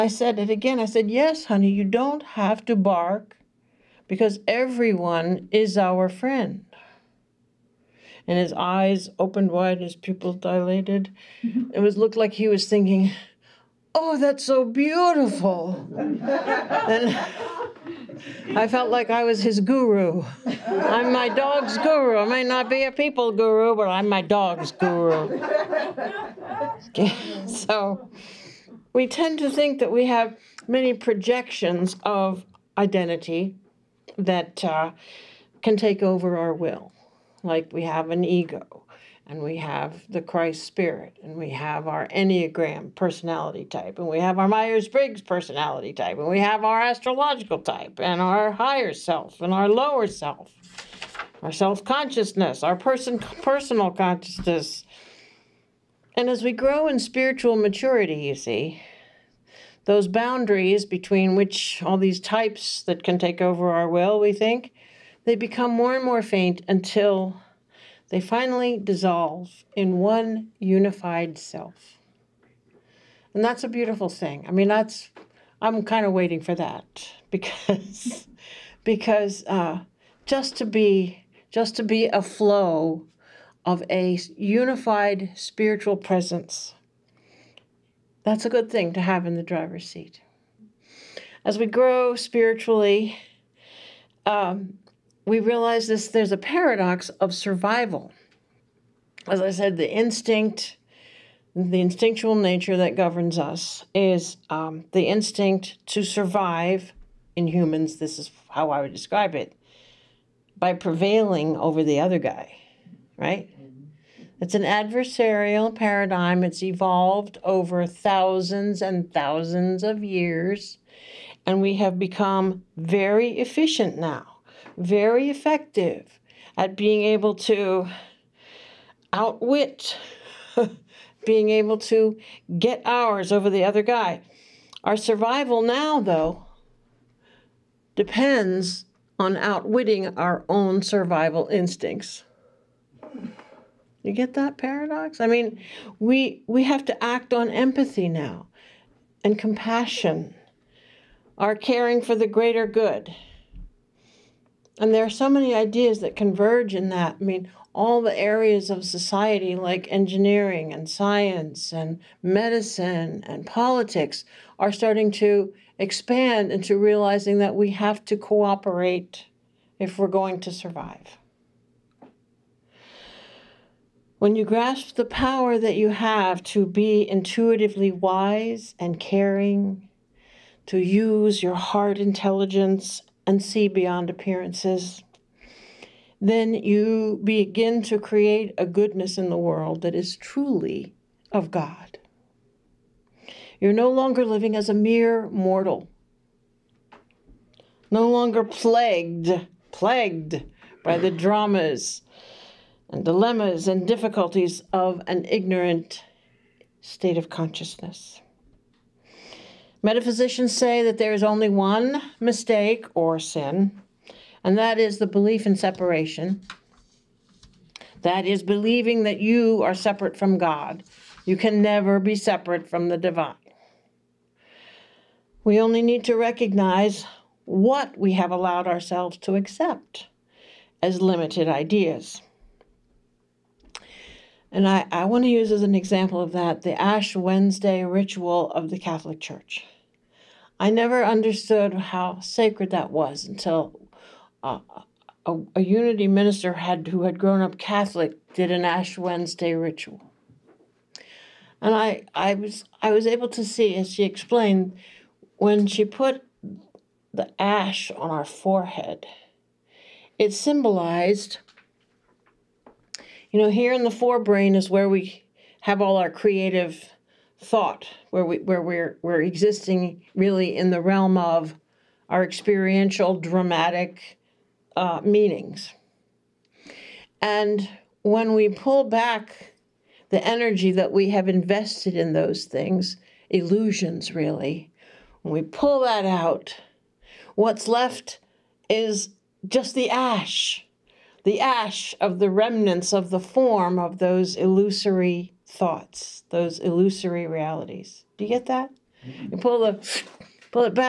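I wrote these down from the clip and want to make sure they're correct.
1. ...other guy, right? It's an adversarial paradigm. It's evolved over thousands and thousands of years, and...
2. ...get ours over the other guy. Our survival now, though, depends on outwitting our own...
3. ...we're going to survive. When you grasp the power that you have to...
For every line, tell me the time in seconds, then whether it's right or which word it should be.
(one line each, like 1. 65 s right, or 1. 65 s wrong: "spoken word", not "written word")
1. 111 s right
2. 132 s right
3. 169 s right.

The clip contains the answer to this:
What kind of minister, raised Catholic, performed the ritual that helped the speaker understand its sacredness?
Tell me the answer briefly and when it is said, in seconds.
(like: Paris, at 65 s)
Unity minister, at 245 s.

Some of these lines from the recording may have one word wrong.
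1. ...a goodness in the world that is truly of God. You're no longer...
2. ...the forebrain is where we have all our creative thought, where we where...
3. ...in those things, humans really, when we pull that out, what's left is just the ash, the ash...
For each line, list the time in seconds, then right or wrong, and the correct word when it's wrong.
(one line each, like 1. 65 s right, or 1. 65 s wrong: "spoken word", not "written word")
1. 188 s right
2. 263 s right
3. 281 s wrong: "illusions", not "humans".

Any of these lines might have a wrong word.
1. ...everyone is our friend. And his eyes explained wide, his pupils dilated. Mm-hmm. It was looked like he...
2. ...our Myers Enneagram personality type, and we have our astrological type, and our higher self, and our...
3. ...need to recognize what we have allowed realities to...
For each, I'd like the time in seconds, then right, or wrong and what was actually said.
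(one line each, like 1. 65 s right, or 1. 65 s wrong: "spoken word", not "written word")
1. 4 s wrong: "opened", not "explained"
2. 44 s wrong: "Briggs", not "Enneagram"
3. 225 s wrong: "ourselves", not "realities".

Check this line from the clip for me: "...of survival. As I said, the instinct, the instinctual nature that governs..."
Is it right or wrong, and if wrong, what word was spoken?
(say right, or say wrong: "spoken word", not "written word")
right.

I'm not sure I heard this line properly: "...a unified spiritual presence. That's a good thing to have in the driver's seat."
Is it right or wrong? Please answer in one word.
right.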